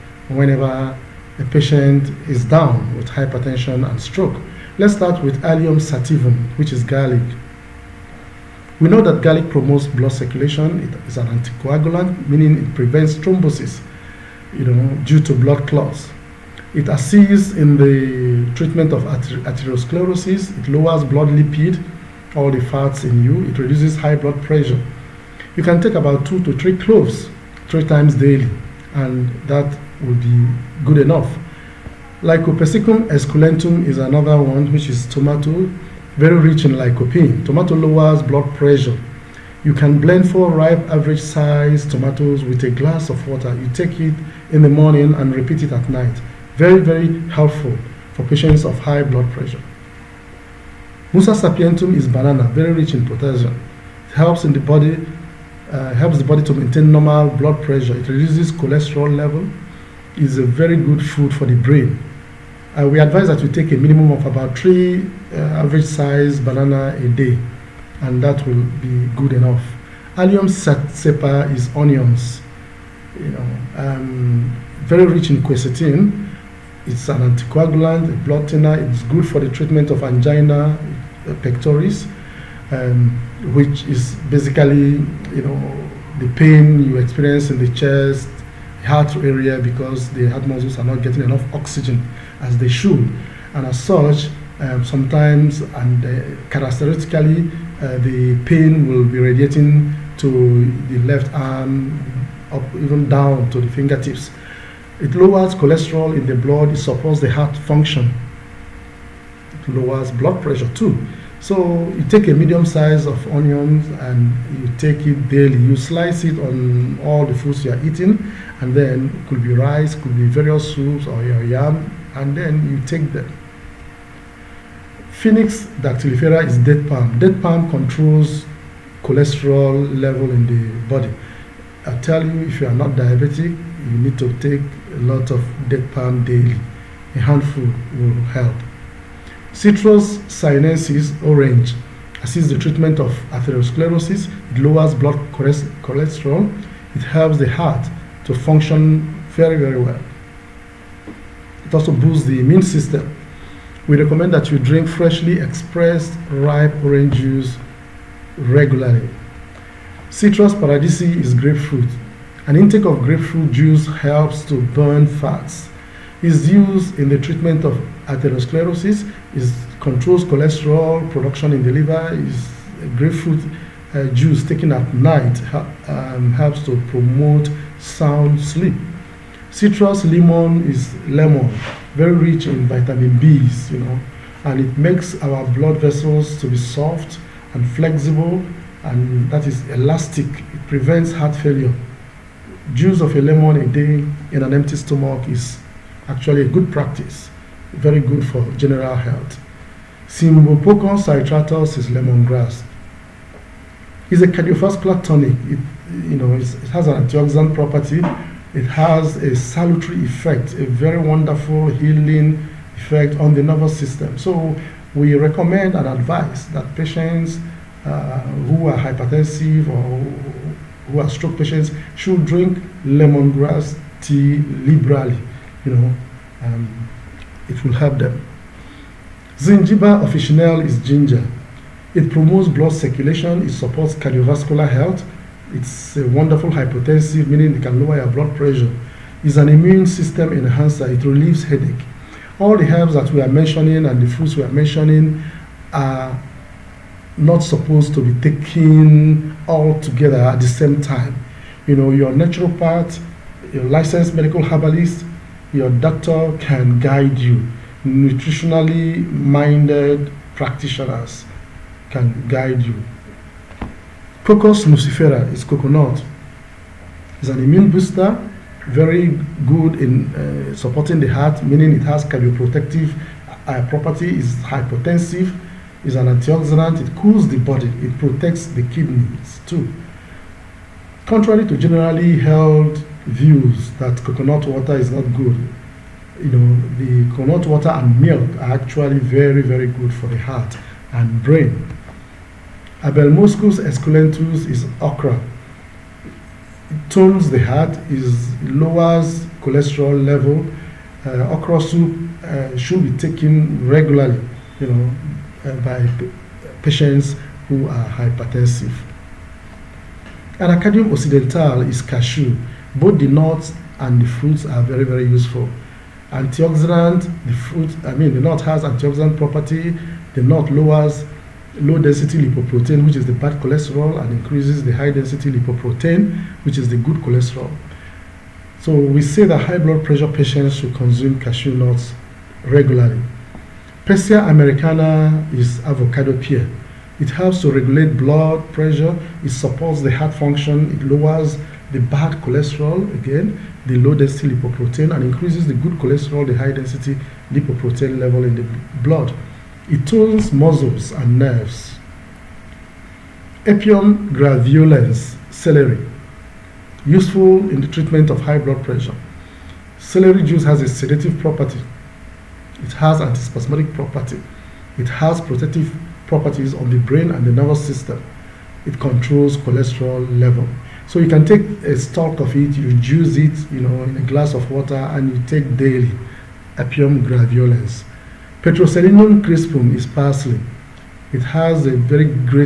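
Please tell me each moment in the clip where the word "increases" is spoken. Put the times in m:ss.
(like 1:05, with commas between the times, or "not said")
5:24, 5:45.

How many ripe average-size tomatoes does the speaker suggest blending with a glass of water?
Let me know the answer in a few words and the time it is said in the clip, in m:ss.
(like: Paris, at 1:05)
4, at 0:40.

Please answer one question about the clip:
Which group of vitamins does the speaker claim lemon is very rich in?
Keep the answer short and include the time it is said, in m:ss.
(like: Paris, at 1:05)
vitamin Bs, at 3:02.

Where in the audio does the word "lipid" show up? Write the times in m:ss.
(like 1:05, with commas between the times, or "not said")
0:21.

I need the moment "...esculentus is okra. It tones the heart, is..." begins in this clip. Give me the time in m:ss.
4:53.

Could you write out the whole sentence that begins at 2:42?
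An intake of grapefruit juice helps to burn fats.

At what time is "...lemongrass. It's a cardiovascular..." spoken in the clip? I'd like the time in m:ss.
3:21.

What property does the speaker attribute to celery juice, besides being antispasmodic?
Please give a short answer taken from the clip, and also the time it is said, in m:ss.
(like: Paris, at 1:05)
sedative, at 6:00.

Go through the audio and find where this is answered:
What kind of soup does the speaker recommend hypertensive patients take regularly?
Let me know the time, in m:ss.
5:01.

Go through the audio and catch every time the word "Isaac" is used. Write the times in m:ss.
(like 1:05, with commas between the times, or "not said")
not said.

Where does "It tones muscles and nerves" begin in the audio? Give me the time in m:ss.
5:49.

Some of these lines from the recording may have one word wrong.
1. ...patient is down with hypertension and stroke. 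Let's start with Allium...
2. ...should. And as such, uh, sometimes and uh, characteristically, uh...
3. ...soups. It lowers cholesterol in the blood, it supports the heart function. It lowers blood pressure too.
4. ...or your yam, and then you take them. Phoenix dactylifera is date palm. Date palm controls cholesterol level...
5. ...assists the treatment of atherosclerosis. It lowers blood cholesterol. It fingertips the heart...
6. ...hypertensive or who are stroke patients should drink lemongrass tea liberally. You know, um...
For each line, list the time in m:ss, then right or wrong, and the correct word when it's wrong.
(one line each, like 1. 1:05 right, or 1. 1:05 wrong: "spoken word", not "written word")
1. 0:01 right
2. 1:32 right
3. 1:43 wrong: "fingertips", not "soups"
4. 2:01 right
5. 2:22 wrong: "helps", not "fingertips"
6. 3:38 right.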